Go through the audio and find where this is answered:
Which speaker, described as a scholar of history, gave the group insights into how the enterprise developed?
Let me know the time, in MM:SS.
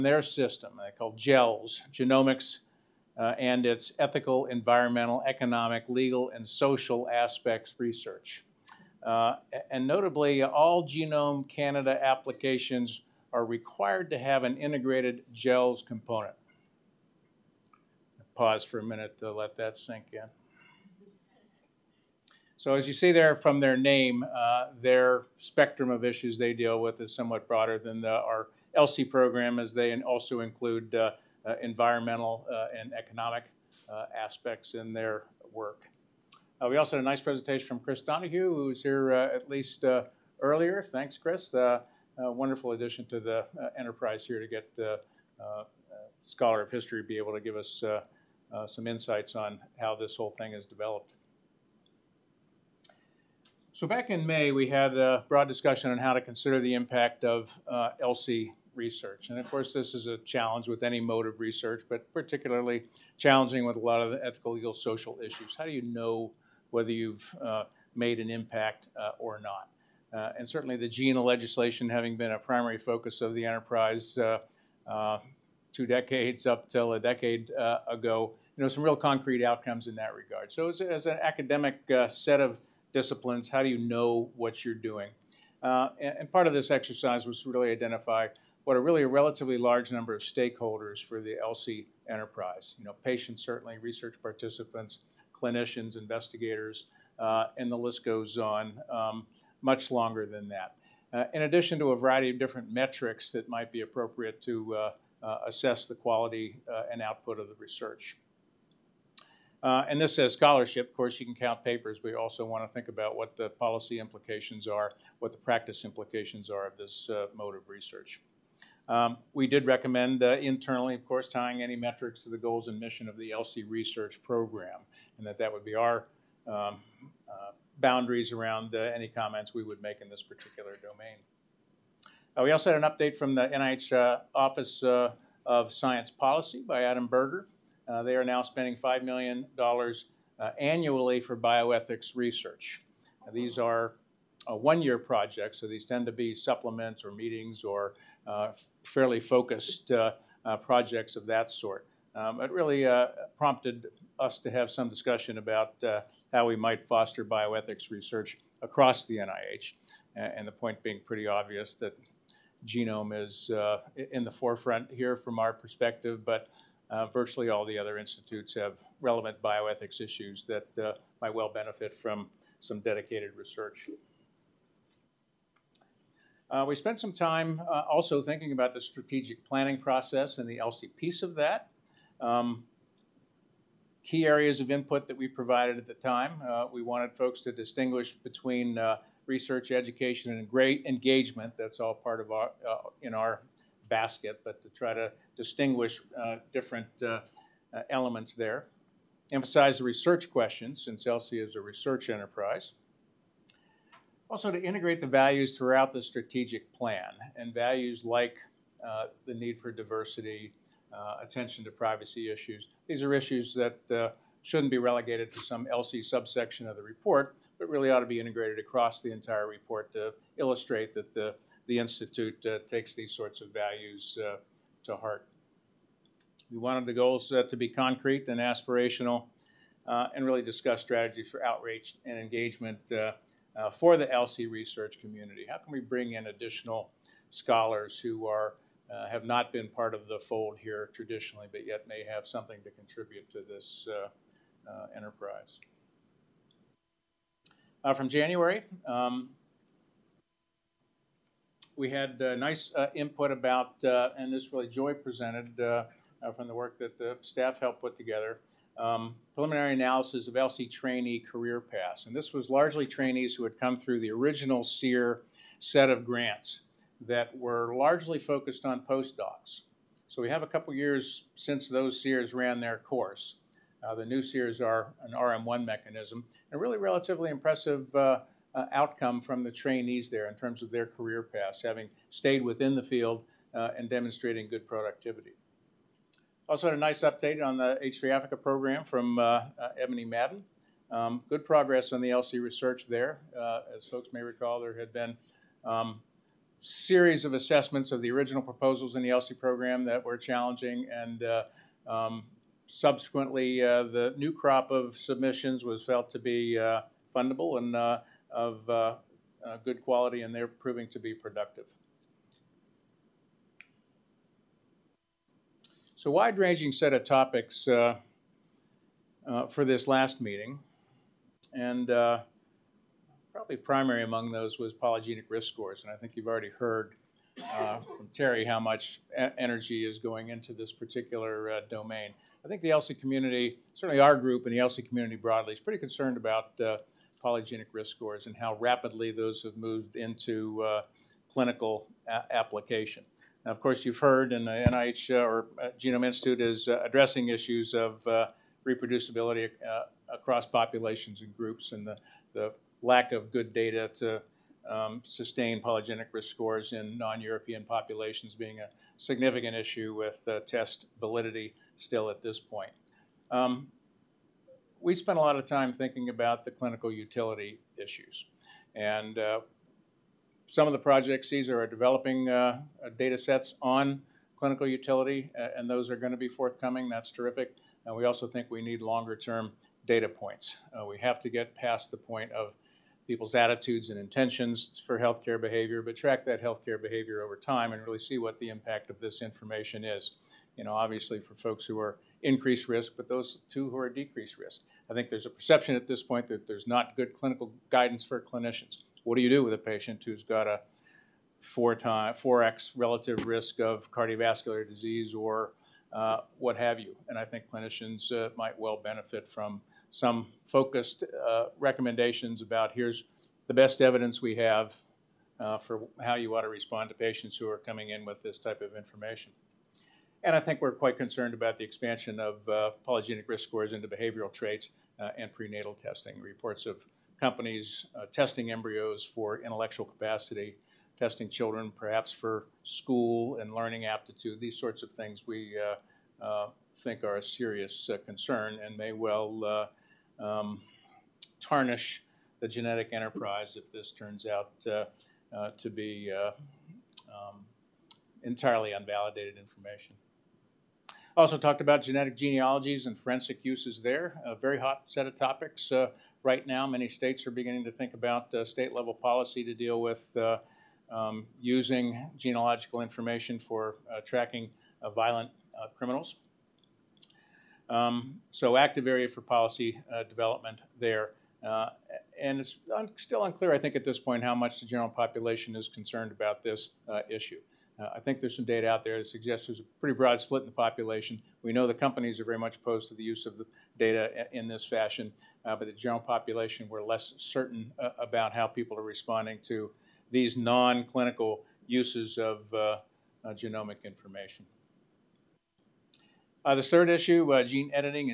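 00:37.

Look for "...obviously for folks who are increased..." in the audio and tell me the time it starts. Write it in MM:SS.
06:30.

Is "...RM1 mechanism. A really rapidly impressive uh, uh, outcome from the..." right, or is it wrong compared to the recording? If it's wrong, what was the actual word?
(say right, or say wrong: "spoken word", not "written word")
wrong: "relatively", not "rapidly".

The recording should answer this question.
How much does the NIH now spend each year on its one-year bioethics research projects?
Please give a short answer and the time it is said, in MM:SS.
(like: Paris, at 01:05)
$5 million, at 02:18.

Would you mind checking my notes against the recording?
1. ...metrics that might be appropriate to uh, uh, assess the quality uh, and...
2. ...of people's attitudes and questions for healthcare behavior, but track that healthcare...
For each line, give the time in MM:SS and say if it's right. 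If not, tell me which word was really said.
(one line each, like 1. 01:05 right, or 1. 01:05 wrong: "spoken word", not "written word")
1. 01:42 right
2. 06:22 wrong: "intentions", not "questions".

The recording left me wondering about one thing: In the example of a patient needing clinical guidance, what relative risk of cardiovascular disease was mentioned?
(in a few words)
4x.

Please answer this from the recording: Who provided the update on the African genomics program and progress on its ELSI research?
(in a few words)
Ebony Madden.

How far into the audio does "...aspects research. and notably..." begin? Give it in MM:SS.
00:07.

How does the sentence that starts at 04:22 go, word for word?
And this was largely trainees who had come through the original CEER set of grants that were largely focused on postdocs.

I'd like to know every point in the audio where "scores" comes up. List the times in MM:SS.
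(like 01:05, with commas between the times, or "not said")
05:25, 05:37, 05:56, 07:03.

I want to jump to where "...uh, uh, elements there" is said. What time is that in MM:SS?
03:17.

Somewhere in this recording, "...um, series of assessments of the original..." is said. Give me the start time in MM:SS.
04:55.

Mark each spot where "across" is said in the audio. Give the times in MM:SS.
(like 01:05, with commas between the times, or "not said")
02:38, 03:38, 05:50.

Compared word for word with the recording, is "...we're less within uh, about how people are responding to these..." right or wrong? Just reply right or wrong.
wrong.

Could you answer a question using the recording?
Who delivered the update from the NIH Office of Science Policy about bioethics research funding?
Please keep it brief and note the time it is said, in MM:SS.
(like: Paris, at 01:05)
Adam Berger, at 02:16.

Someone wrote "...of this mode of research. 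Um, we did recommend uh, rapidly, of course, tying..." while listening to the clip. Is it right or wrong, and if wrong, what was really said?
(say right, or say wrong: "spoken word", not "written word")
wrong: "internally", not "rapidly".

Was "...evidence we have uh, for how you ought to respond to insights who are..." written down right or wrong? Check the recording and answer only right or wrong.
wrong.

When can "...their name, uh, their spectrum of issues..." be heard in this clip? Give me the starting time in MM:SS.
00:23.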